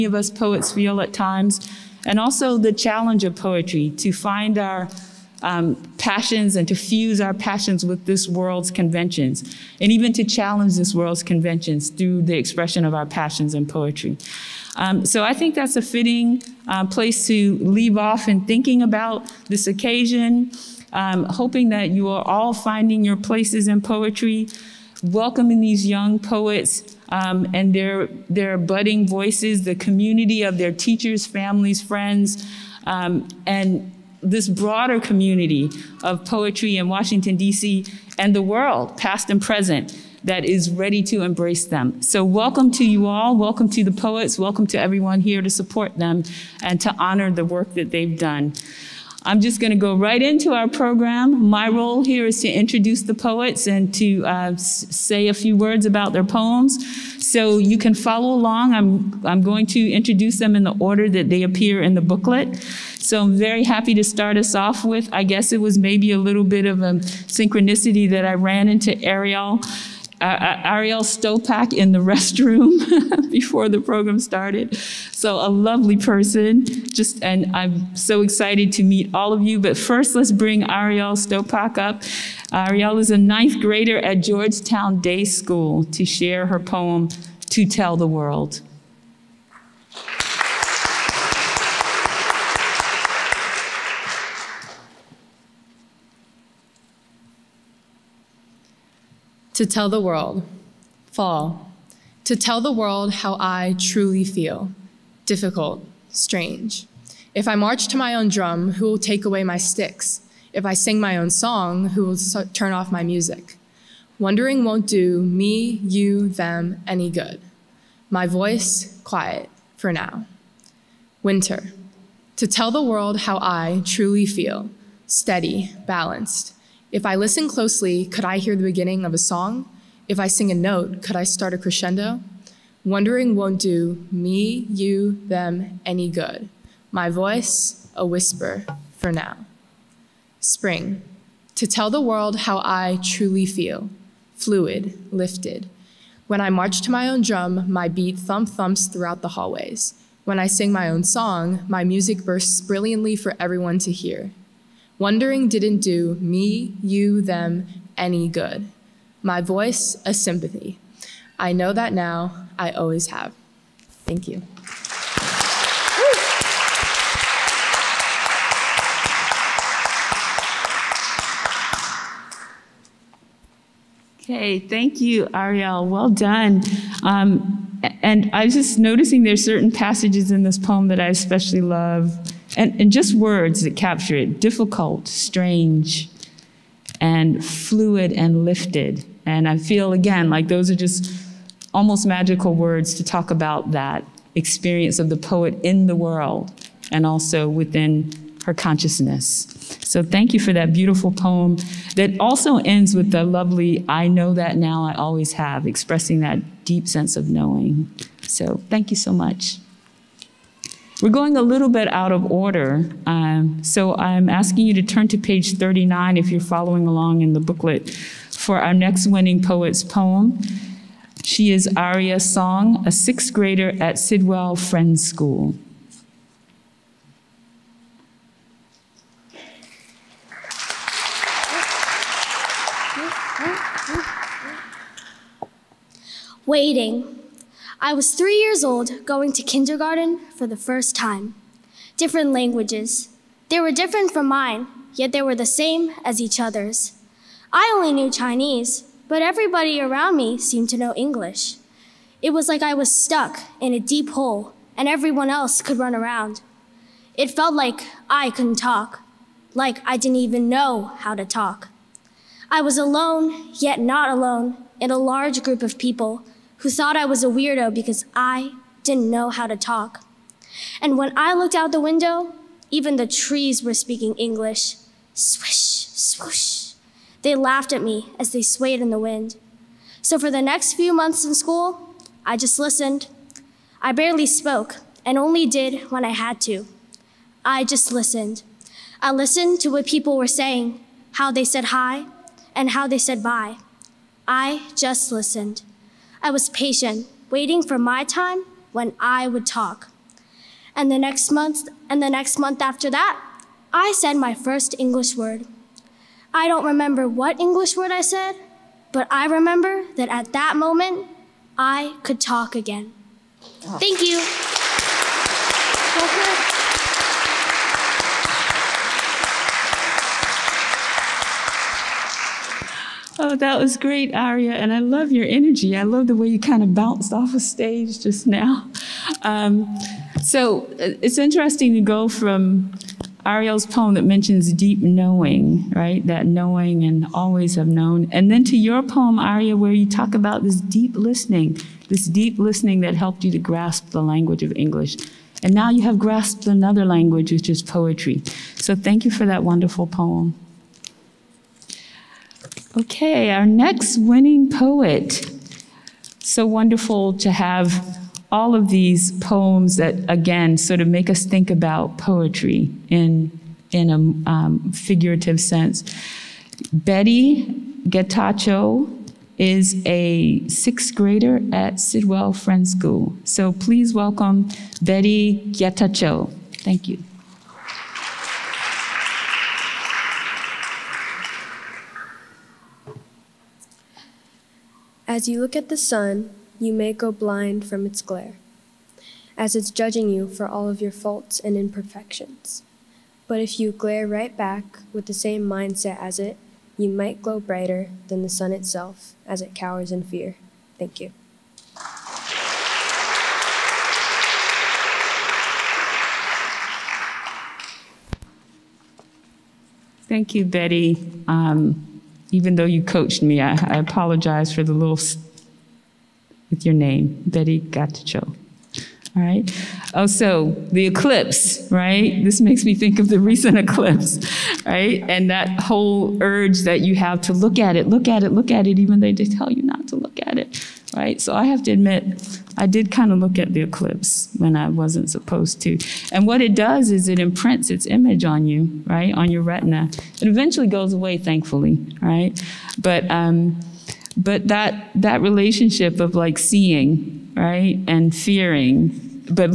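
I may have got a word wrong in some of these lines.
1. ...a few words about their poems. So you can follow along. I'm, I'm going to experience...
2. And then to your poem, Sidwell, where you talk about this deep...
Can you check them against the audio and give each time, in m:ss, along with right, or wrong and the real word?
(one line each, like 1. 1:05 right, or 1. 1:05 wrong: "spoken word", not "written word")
1. 0:55 wrong: "introduce", not "experience"
2. 5:38 wrong: "Aria", not "Sidwell".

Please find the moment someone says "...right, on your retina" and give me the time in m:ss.
7:18.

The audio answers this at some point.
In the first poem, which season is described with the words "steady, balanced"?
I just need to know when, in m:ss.
2:01.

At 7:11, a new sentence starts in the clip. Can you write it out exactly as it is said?
So I have to admit, I did kind of look at the eclipse when I wasn't supposed to.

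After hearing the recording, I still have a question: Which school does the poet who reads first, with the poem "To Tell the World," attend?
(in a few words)
Georgetown Day School.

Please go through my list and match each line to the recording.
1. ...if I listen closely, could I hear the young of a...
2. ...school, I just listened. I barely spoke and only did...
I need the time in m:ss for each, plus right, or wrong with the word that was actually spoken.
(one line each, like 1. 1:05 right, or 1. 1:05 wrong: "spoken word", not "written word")
1. 2:06 wrong: "beginning", not "young"
2. 4:41 right.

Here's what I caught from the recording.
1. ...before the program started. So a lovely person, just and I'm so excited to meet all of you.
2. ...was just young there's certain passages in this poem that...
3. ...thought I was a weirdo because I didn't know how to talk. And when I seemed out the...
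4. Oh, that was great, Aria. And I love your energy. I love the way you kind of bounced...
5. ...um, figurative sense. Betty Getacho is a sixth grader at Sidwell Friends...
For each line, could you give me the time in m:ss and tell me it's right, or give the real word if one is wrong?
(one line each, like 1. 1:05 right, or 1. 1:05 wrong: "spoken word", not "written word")
1. 1:13 right
2. 2:58 wrong: "noticing", not "young"
3. 4:26 wrong: "looked", not "seemed"
4. 5:23 right
5. 6:04 right.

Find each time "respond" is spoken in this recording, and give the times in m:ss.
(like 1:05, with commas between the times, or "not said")
not said.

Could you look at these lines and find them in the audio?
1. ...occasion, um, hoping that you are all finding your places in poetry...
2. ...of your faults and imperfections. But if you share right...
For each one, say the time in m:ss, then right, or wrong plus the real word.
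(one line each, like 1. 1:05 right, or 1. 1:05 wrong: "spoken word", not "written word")
1. 0:19 right
2. 6:30 wrong: "glare", not "share".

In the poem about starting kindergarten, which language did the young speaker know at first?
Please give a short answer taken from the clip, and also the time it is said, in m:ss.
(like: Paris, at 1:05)
Chinese, at 4:08.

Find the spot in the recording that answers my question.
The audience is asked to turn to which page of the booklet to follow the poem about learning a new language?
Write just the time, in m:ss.
3:35.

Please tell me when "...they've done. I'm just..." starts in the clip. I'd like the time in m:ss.
0:47.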